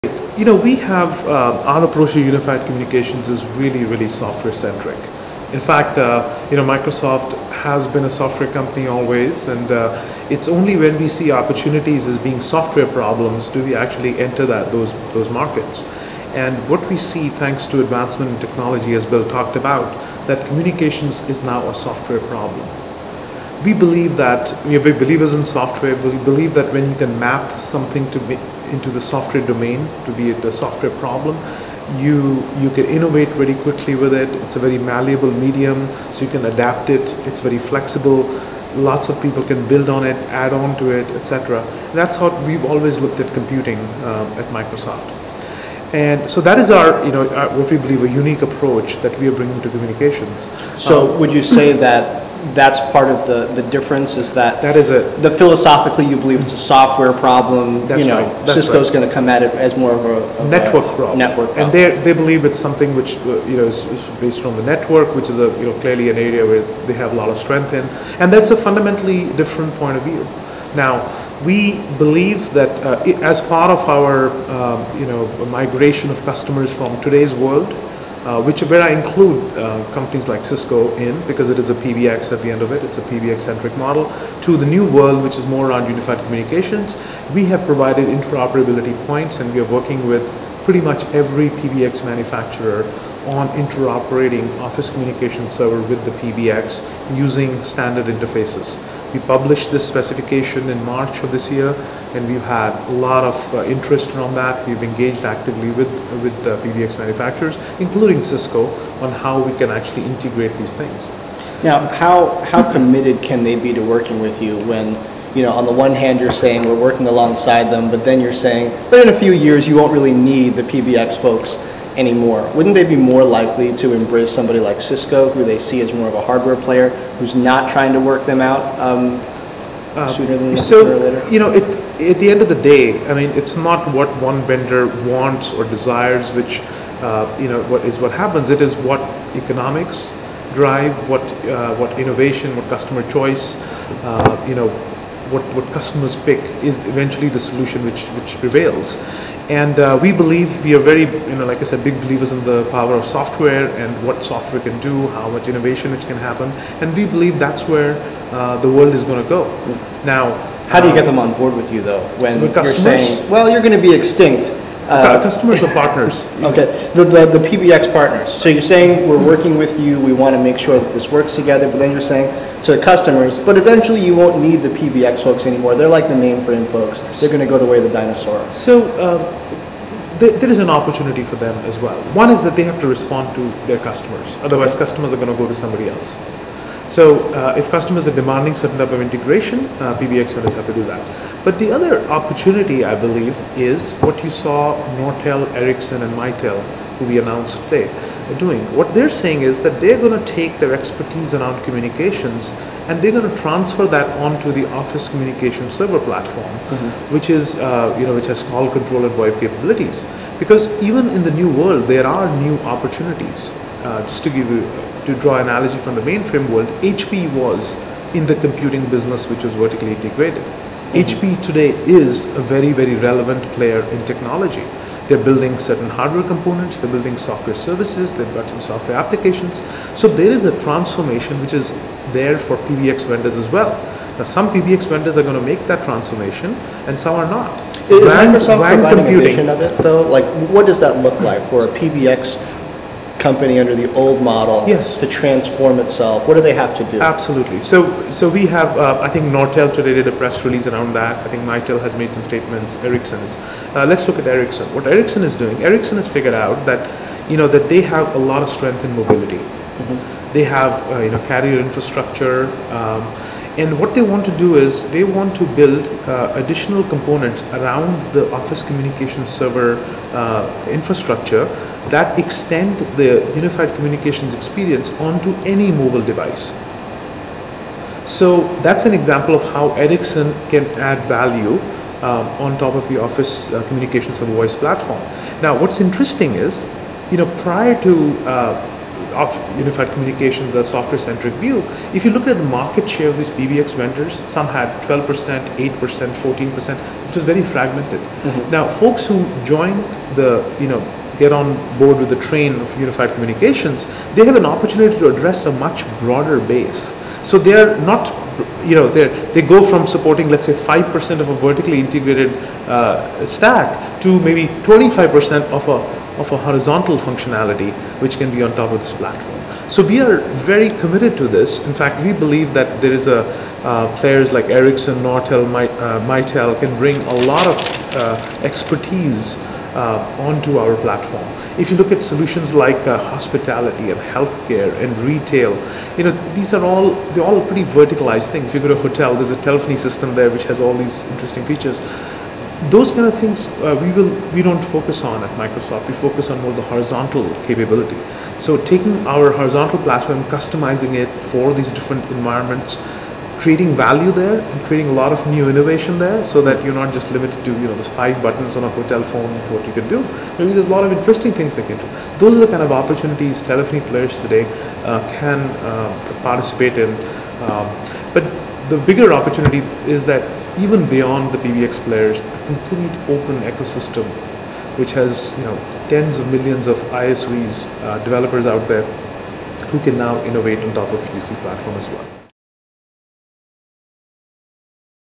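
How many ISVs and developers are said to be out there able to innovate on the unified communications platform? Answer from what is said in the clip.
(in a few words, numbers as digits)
Tens of millions.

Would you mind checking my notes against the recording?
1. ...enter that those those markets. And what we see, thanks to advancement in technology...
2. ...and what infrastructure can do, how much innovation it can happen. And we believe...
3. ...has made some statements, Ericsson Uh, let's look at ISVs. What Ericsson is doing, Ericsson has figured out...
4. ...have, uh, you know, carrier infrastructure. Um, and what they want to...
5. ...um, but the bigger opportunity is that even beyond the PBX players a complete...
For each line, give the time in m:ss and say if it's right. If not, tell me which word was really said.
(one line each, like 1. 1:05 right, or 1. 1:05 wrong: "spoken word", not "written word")
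1. 0:14 right
2. 2:33 wrong: "software", not "infrastructure"
3. 4:11 wrong: "Ericsson", not "ISVs"
4. 4:20 right
5. 6:07 right.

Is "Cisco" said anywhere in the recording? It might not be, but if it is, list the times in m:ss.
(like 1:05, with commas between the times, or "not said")
0:58, 1:20, 1:48, 2:04.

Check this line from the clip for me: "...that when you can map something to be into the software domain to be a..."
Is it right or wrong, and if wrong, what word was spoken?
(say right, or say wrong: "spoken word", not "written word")
right.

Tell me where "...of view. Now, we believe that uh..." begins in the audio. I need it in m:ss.
1:09.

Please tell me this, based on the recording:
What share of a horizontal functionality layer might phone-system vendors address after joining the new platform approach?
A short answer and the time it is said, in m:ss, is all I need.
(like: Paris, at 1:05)
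25%, at 5:14.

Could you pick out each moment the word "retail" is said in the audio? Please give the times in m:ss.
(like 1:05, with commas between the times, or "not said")
5:34.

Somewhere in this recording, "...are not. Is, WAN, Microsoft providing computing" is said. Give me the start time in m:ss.
3:57.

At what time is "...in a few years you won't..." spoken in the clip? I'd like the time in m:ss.
1:59.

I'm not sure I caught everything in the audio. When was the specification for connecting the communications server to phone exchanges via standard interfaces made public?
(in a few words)
March.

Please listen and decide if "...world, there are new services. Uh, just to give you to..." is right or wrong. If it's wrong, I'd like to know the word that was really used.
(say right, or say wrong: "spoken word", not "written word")
wrong: "opportunities", not "services".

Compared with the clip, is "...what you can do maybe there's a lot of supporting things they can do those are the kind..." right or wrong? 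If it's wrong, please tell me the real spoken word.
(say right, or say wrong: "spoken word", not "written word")
wrong: "interesting", not "supporting".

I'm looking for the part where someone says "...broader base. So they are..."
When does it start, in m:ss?
5:05.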